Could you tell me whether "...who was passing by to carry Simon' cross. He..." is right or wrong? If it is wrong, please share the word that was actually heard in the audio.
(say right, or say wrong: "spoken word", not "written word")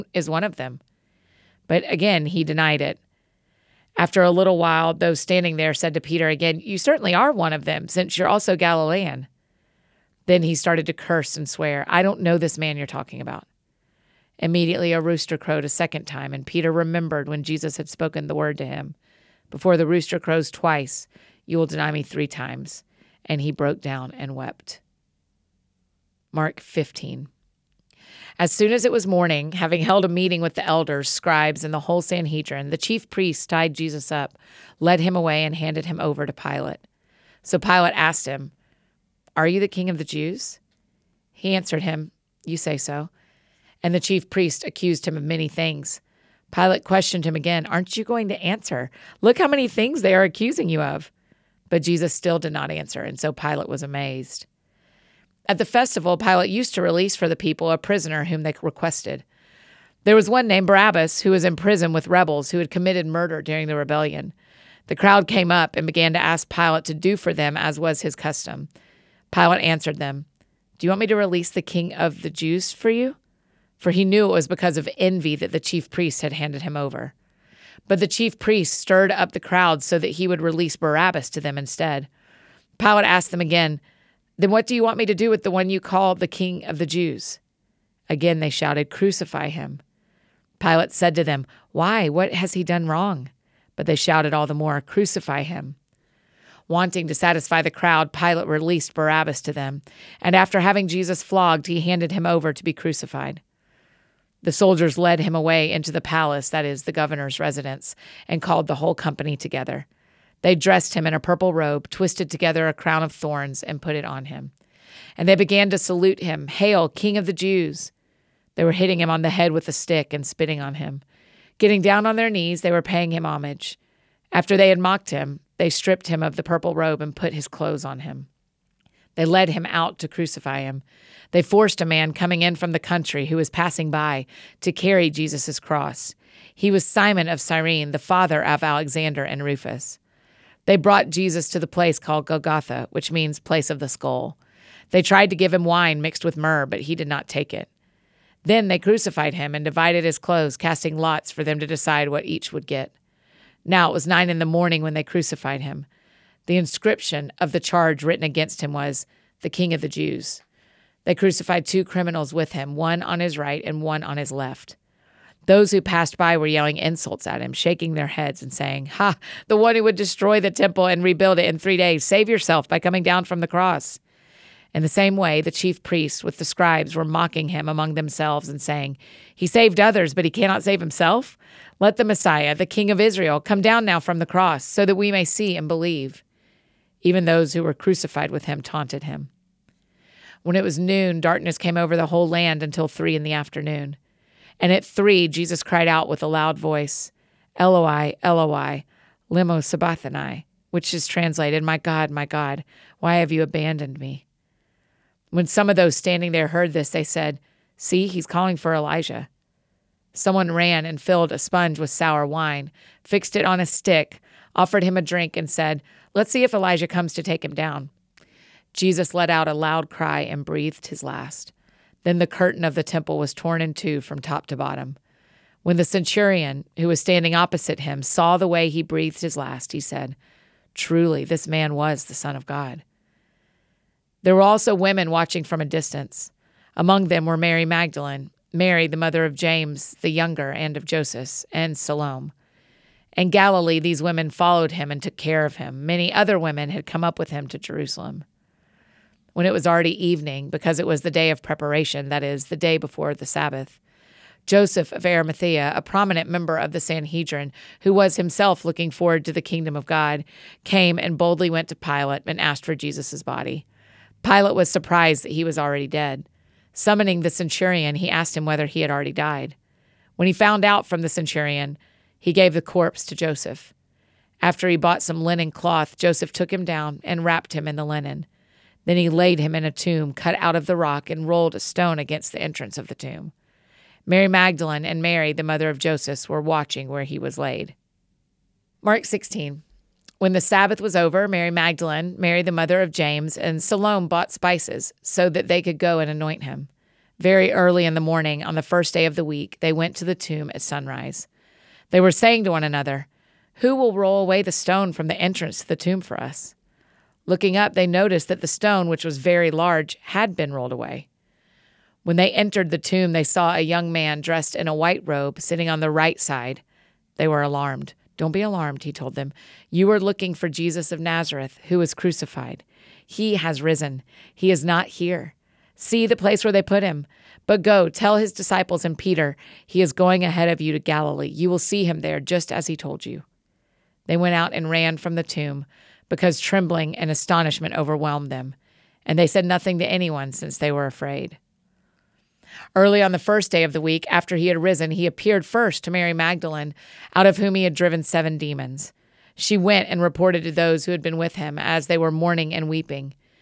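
wrong: "Jesus", not "Simon".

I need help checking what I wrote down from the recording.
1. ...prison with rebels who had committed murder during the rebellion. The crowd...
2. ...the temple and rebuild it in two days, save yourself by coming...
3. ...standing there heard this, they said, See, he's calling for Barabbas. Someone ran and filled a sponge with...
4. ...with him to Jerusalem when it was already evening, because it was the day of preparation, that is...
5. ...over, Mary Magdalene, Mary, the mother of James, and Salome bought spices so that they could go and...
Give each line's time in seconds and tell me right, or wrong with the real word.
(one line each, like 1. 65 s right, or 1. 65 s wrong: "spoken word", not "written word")
1. 61 s right
2. 170 s wrong: "three", not "two"
3. 205 s wrong: "Elijah", not "Barabbas"
4. 247 s right
5. 290 s right.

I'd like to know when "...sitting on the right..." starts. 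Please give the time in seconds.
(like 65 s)
315 s.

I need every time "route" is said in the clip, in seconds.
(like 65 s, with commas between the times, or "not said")
not said.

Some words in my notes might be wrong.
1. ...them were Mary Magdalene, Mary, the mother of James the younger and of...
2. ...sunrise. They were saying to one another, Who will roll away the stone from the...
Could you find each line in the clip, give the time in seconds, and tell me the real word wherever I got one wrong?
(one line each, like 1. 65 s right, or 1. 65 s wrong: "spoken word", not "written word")
1. 237 s right
2. 300 s right.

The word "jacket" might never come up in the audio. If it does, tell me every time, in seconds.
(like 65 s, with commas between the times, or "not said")
not said.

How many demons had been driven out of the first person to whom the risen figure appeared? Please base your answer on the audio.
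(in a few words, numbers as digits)
7.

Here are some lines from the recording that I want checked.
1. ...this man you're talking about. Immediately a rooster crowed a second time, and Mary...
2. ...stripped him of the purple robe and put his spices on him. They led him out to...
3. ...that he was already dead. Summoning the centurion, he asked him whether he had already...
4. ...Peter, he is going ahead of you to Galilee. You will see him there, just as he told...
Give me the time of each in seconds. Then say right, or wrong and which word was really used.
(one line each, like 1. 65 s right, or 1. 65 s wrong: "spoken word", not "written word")
1. 12 s wrong: "Peter", not "Mary"
2. 125 s wrong: "clothes", not "spices"
3. 265 s right
4. 328 s right.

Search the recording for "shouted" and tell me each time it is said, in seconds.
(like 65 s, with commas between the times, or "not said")
88 s, 93 s.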